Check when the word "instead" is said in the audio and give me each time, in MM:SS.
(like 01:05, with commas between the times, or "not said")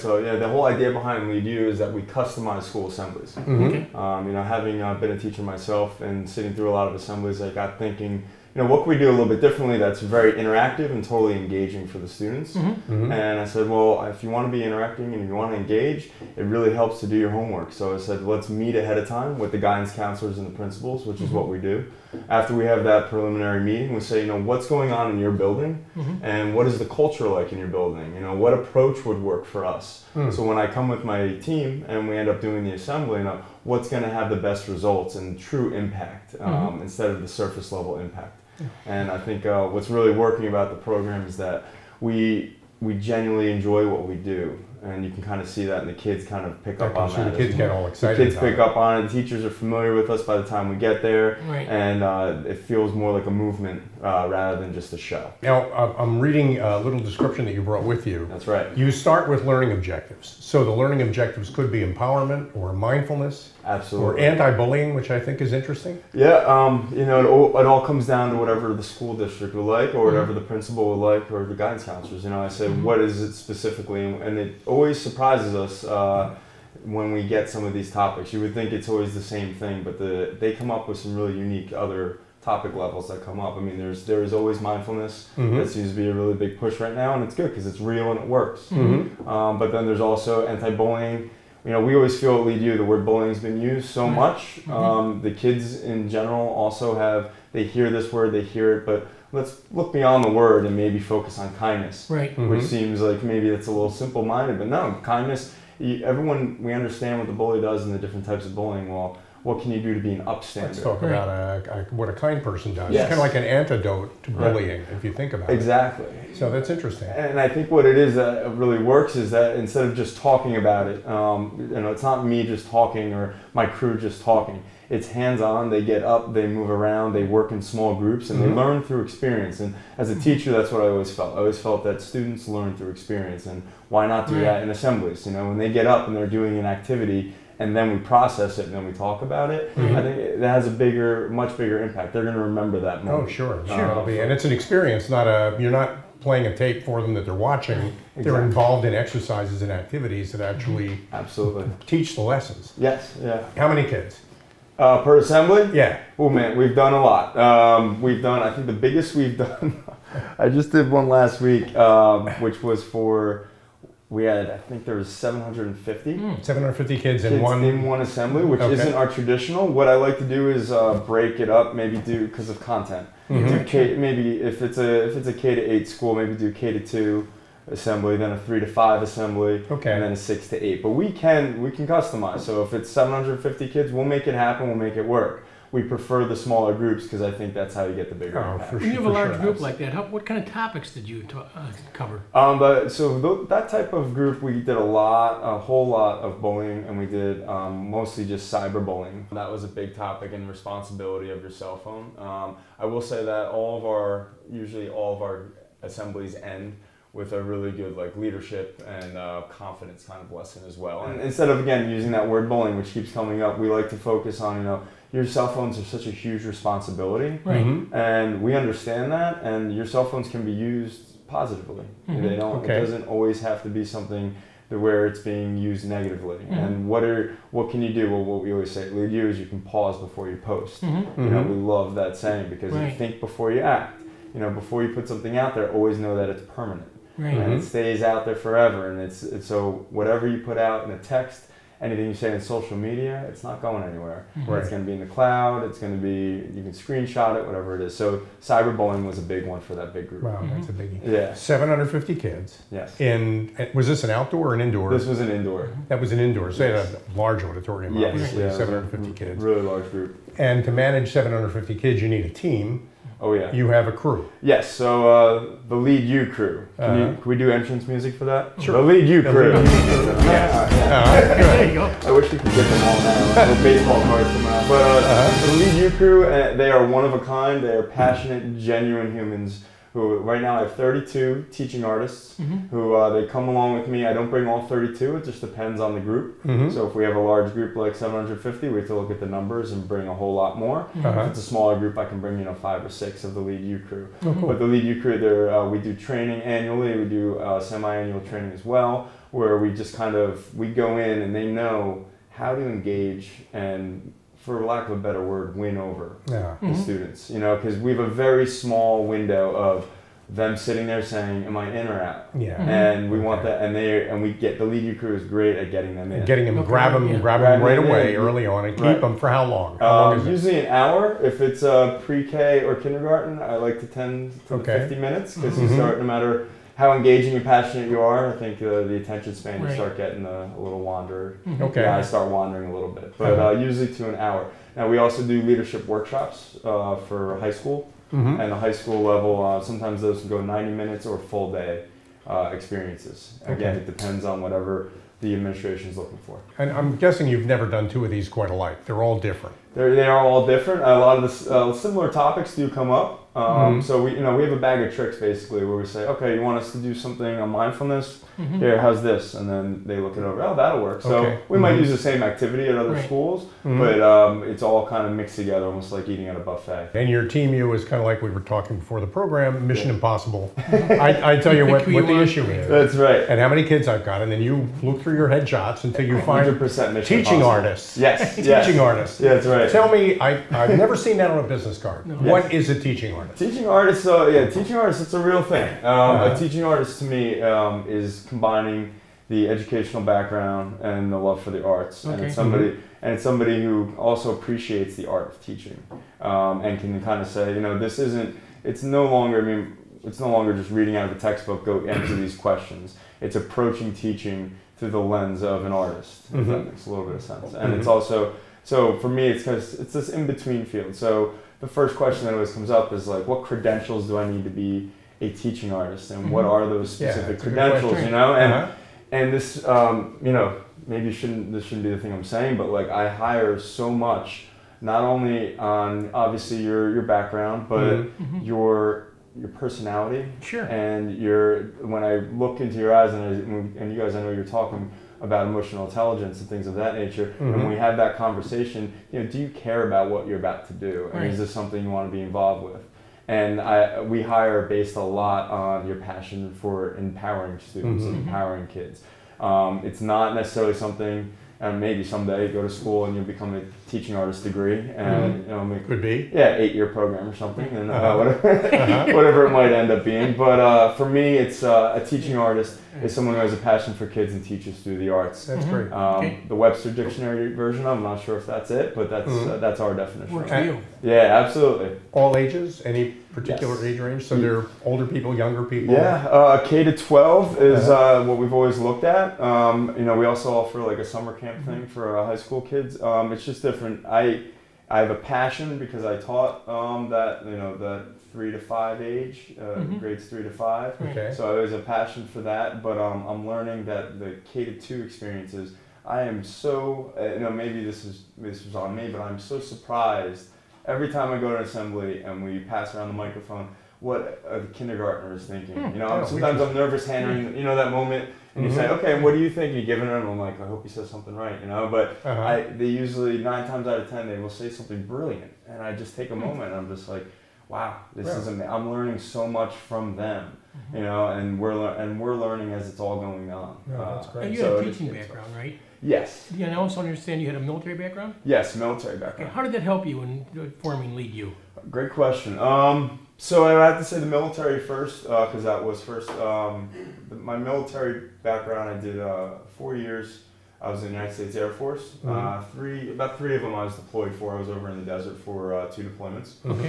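00:36, 01:59, 03:31.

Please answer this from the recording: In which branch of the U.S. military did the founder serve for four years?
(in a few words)
Air Force.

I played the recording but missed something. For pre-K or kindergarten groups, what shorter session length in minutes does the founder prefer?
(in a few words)
50 minutes.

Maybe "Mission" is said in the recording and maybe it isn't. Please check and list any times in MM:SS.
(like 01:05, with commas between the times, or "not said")
06:09, 06:16.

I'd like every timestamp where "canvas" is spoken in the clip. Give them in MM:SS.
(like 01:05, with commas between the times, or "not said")
not said.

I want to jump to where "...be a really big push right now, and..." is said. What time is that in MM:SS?
01:25.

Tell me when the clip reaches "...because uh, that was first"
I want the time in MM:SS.
08:55.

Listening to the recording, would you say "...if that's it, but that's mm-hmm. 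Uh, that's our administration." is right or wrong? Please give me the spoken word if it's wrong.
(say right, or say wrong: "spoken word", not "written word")
wrong: "definition", not "administration".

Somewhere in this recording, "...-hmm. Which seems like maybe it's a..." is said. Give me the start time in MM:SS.
01:42.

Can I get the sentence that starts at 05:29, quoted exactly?
you start getting a, uh, a little wanderer.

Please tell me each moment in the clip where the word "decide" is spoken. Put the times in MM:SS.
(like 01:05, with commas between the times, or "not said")
not said.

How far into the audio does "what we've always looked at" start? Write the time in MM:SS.
07:58.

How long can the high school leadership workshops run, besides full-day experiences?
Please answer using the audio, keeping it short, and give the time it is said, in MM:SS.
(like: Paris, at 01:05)
90 minutes, at 05:40.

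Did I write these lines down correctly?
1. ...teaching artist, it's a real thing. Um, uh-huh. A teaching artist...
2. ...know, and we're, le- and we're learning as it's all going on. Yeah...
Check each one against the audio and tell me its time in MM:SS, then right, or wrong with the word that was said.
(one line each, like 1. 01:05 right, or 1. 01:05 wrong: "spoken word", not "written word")
1. 06:24 right
2. 08:41 right.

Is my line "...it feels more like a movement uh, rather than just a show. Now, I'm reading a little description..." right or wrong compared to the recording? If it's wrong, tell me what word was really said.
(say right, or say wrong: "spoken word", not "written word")
right.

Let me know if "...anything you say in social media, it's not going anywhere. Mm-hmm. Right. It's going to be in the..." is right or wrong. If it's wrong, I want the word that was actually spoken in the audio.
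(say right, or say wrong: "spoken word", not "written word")
right.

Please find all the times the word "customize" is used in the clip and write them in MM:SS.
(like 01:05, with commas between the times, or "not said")
00:02, 03:01.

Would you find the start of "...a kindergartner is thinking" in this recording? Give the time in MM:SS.
08:24.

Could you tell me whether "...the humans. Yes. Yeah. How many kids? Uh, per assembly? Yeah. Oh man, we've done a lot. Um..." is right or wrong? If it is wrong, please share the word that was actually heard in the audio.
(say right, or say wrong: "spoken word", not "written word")
wrong: "lessons", not "humans".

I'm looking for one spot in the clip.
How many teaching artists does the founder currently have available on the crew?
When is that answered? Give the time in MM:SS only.
04:40.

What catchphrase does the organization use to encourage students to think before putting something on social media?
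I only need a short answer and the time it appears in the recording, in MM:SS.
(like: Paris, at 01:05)
pause before you post, at 03:49.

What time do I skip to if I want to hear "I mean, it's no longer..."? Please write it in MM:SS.
06:39.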